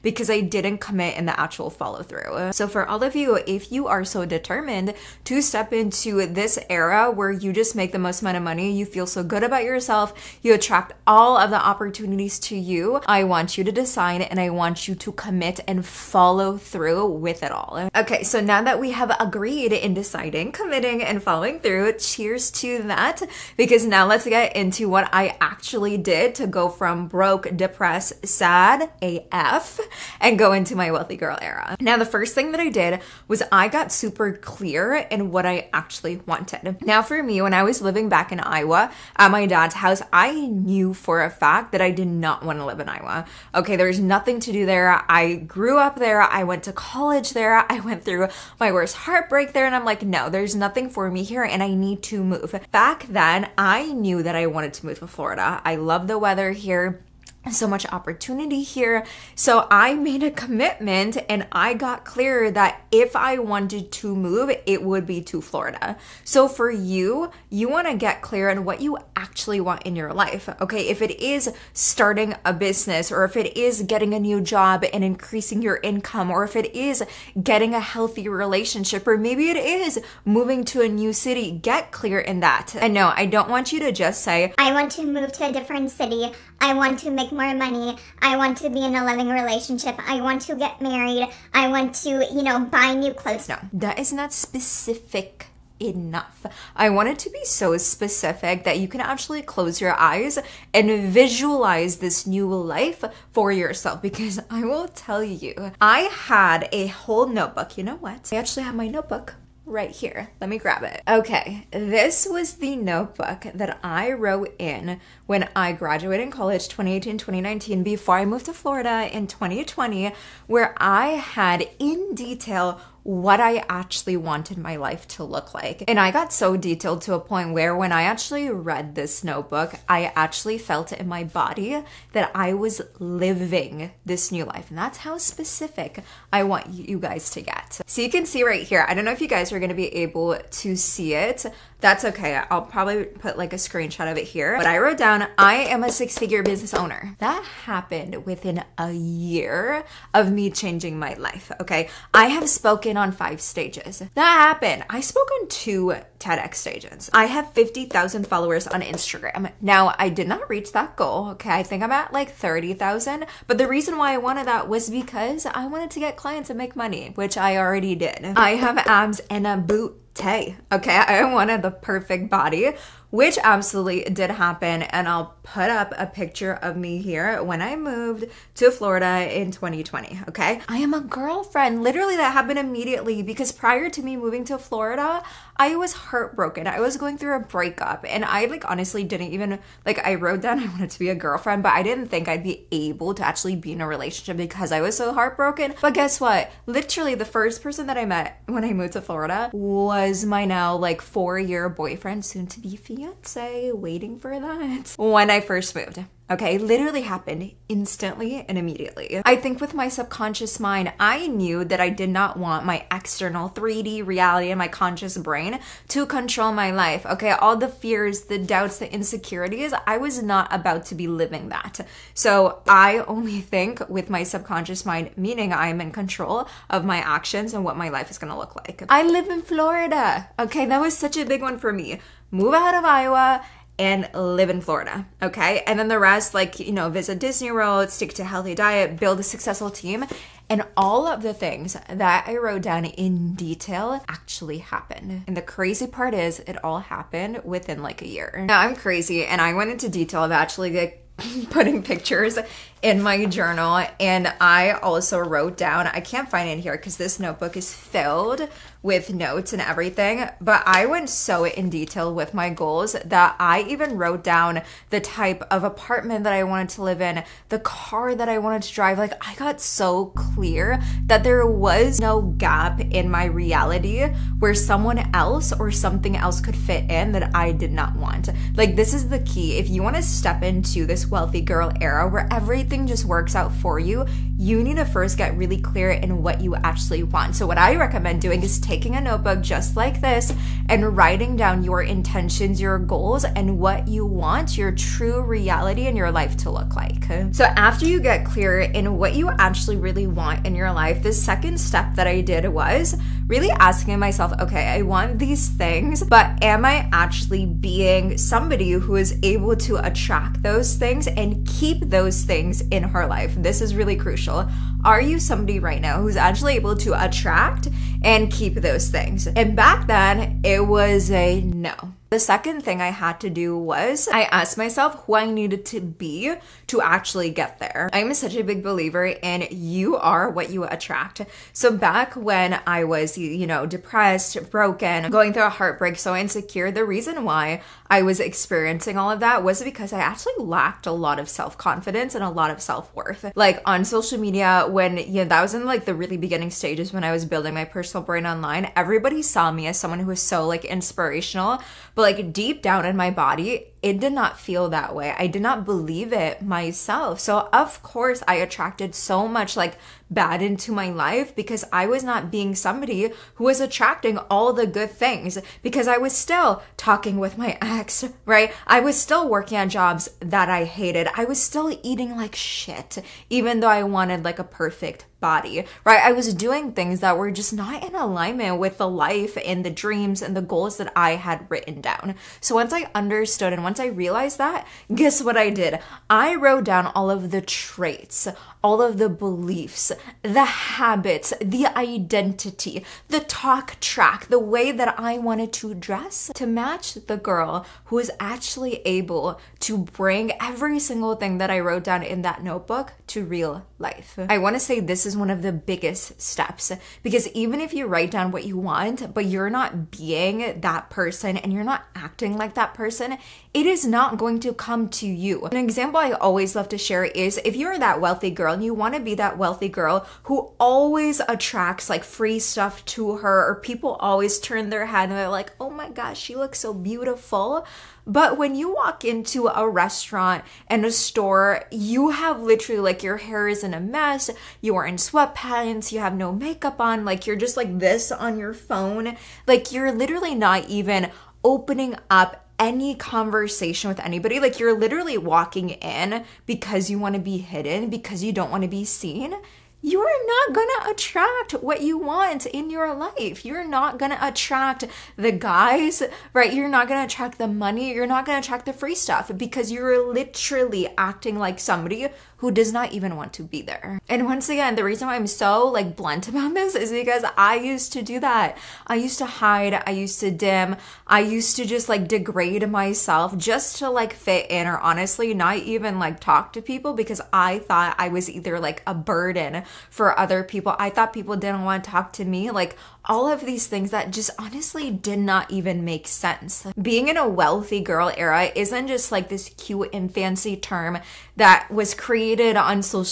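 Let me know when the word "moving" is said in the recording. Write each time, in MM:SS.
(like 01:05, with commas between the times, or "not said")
01:20, 03:04.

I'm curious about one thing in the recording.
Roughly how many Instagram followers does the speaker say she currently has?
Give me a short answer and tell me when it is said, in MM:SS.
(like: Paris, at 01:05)
30,000, at 02:42.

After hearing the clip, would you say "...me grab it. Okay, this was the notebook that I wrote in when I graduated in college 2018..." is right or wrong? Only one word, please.
right.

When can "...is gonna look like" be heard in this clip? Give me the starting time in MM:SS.
03:48.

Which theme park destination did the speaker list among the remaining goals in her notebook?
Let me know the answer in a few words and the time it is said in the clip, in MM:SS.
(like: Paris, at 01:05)
Disney World, at 03:57.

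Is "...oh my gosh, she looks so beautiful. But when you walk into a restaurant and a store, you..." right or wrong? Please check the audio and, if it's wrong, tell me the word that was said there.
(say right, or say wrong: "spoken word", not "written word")
right.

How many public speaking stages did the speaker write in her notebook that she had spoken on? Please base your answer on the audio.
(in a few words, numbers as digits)
5.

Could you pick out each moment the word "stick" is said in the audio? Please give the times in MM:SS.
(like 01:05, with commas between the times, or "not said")
03:57.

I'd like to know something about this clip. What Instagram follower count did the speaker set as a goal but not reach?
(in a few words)
50,000.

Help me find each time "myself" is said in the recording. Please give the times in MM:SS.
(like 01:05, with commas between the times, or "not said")
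05:03, 05:24, 05:56, 07:52.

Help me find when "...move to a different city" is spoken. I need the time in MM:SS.
01:25.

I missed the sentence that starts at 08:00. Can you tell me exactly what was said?
I thought people didn't want to talk to me.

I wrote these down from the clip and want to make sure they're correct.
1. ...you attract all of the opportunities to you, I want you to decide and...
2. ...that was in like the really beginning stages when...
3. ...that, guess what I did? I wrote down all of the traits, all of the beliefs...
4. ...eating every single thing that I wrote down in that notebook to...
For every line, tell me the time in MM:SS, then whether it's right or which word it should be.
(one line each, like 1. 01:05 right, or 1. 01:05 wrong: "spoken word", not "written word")
1. 00:10 right
2. 05:45 right
3. 06:24 right
4. 06:39 wrong: "bring", not "eating".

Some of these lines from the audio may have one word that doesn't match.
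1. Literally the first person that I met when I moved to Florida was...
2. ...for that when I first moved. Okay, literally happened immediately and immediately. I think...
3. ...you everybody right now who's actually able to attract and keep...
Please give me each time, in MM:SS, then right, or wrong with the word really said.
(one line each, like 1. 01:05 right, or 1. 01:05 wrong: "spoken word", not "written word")
1. 03:16 right
2. 03:24 wrong: "instantly", not "immediately"
3. 05:15 wrong: "somebody", not "everybody".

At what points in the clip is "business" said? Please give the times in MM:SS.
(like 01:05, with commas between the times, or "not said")
01:12, 02:26.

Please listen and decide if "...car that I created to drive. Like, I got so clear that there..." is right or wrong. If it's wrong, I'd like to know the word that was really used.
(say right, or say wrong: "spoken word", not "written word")
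wrong: "wanted", not "created".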